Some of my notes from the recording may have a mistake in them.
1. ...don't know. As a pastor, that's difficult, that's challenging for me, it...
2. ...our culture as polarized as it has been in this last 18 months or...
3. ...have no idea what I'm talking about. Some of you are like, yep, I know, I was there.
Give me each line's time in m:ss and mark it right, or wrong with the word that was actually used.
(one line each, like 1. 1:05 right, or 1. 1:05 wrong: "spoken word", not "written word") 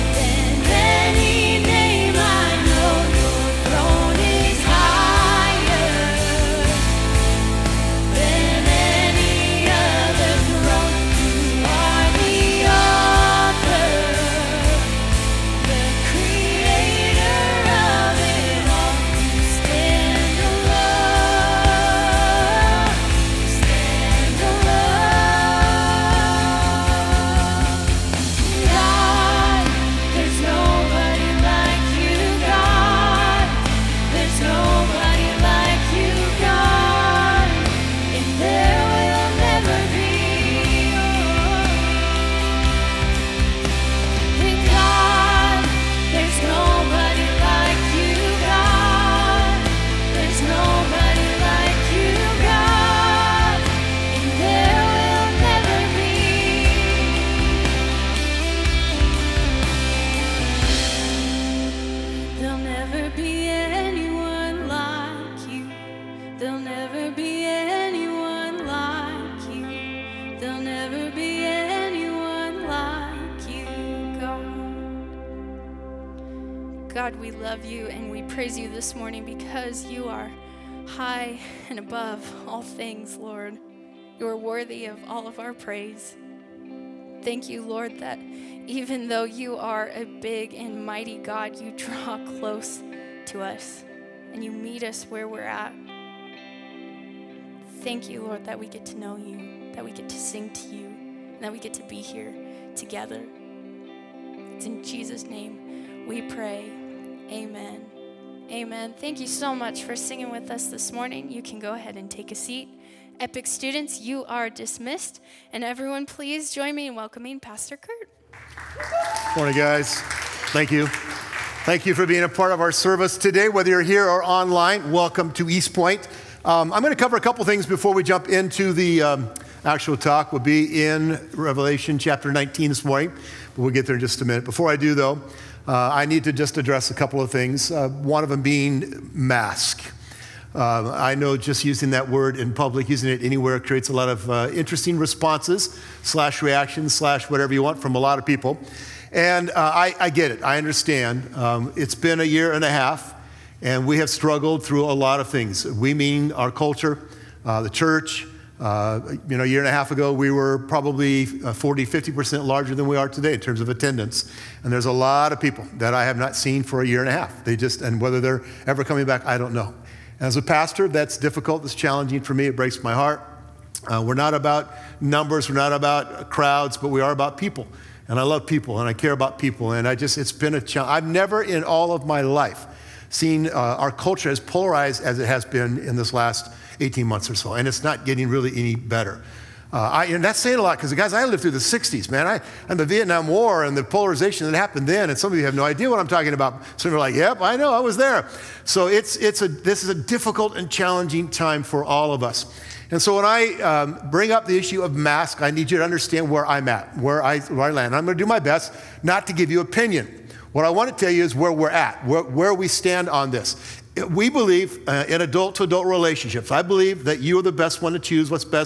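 1. 2:49 right
2. 3:03 right
3. 3:15 right.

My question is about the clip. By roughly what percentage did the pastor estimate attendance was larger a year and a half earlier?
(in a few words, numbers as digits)
40-50%.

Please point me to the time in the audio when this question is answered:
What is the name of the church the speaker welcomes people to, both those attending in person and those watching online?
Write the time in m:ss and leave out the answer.
2:05.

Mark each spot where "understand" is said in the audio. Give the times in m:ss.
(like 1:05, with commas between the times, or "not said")
2:30, 3:25.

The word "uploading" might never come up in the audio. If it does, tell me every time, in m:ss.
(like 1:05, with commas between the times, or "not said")
not said.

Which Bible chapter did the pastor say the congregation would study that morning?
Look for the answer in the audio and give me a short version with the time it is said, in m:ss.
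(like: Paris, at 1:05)
Revelation 19, at 2:11.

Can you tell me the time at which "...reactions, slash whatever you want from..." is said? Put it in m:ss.
2:26.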